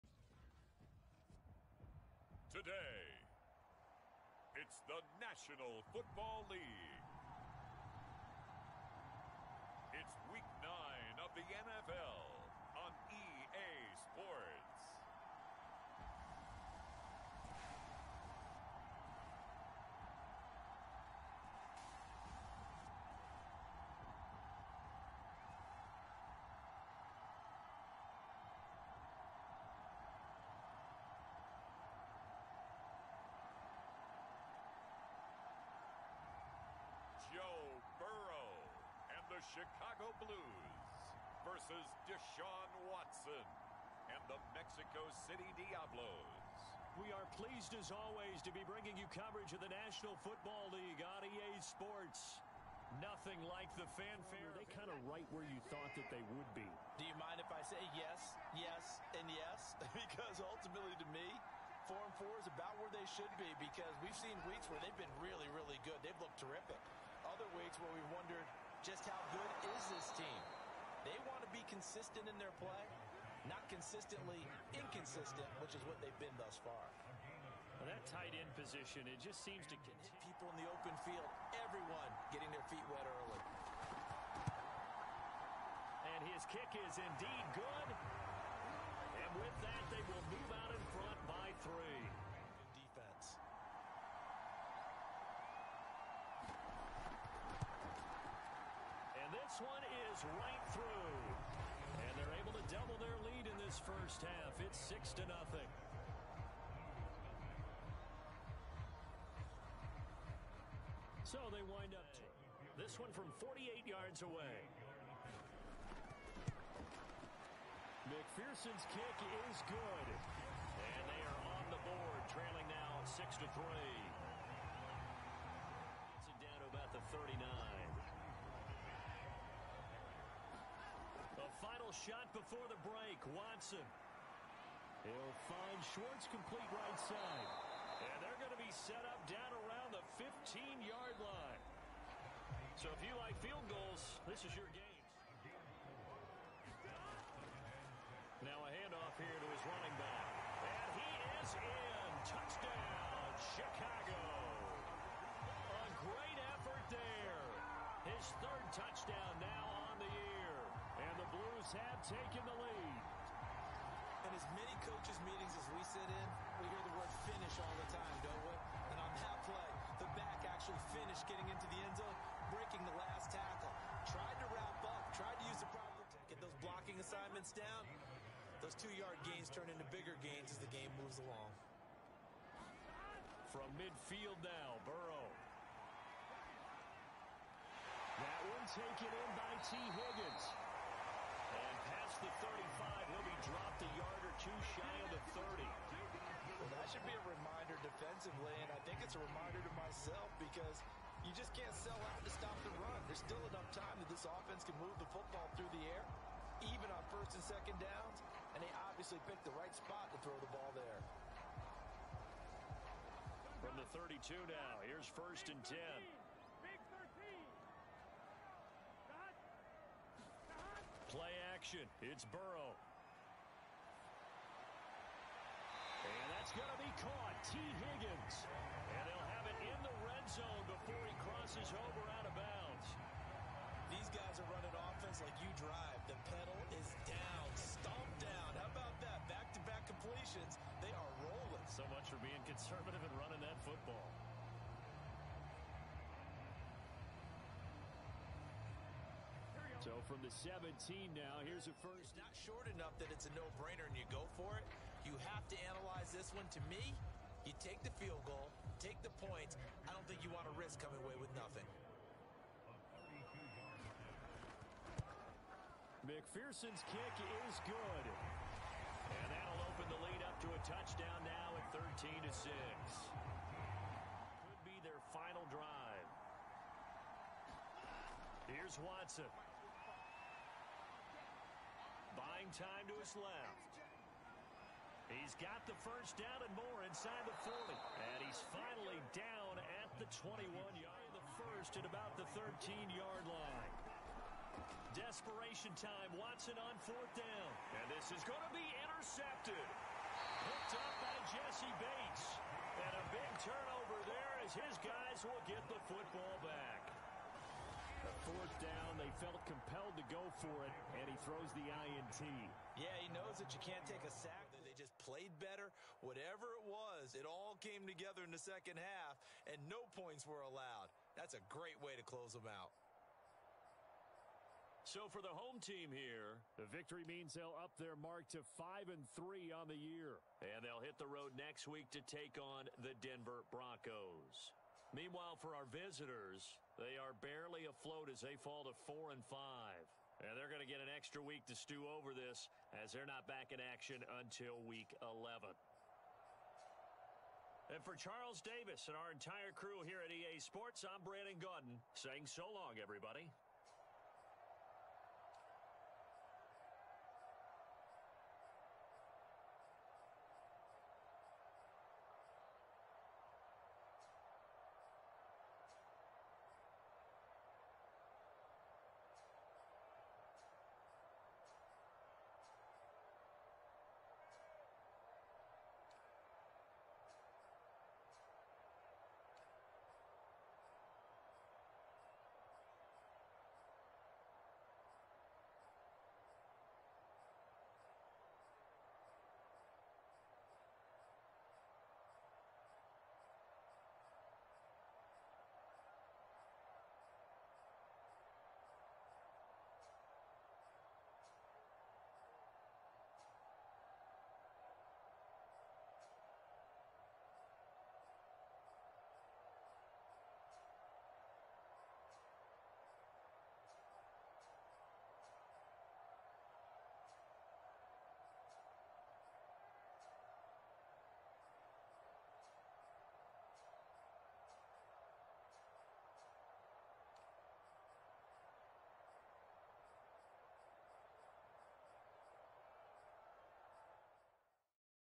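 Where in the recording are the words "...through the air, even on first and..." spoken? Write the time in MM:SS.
03:25.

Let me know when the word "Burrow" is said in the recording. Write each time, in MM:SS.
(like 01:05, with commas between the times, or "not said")
03:04, 03:42.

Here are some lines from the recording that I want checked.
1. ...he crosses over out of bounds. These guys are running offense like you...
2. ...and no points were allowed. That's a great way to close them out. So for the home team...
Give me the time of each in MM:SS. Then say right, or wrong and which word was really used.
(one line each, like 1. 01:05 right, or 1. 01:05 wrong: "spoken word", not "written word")
1. 03:51 right
2. 05:19 right.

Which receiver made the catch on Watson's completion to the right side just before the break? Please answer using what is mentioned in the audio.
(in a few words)
Schwartz.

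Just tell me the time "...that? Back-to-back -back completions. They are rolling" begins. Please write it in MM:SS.
03:59.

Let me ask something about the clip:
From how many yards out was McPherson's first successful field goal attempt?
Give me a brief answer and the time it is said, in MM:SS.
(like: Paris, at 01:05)
48, at 01:53.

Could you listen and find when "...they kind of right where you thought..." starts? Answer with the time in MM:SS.
00:54.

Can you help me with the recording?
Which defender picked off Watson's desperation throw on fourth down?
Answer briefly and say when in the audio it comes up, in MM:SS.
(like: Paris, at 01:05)
Jessie Bates, at 05:01.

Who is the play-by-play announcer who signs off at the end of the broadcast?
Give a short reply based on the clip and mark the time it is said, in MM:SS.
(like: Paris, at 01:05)
Brandon Gaudin, at 05:51.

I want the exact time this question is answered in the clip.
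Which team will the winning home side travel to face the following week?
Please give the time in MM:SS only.
05:32.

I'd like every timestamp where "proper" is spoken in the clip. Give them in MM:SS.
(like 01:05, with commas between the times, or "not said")
02:55.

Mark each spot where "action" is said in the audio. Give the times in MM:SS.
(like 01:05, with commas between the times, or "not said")
03:41, 05:43.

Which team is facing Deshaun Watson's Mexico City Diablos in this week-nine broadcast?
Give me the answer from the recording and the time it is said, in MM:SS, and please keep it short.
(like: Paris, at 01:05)
Chicago Blues, at 00:39.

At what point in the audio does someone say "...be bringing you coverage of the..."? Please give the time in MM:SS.
00:48.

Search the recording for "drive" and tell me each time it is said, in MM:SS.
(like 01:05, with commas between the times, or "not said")
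03:55, 04:35.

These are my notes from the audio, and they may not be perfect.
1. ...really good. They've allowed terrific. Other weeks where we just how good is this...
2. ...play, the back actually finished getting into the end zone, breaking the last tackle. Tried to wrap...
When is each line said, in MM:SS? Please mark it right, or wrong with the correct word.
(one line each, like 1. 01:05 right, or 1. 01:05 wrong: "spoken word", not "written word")
1. 01:05 wrong: "looked", not "allowed"
2. 02:49 right.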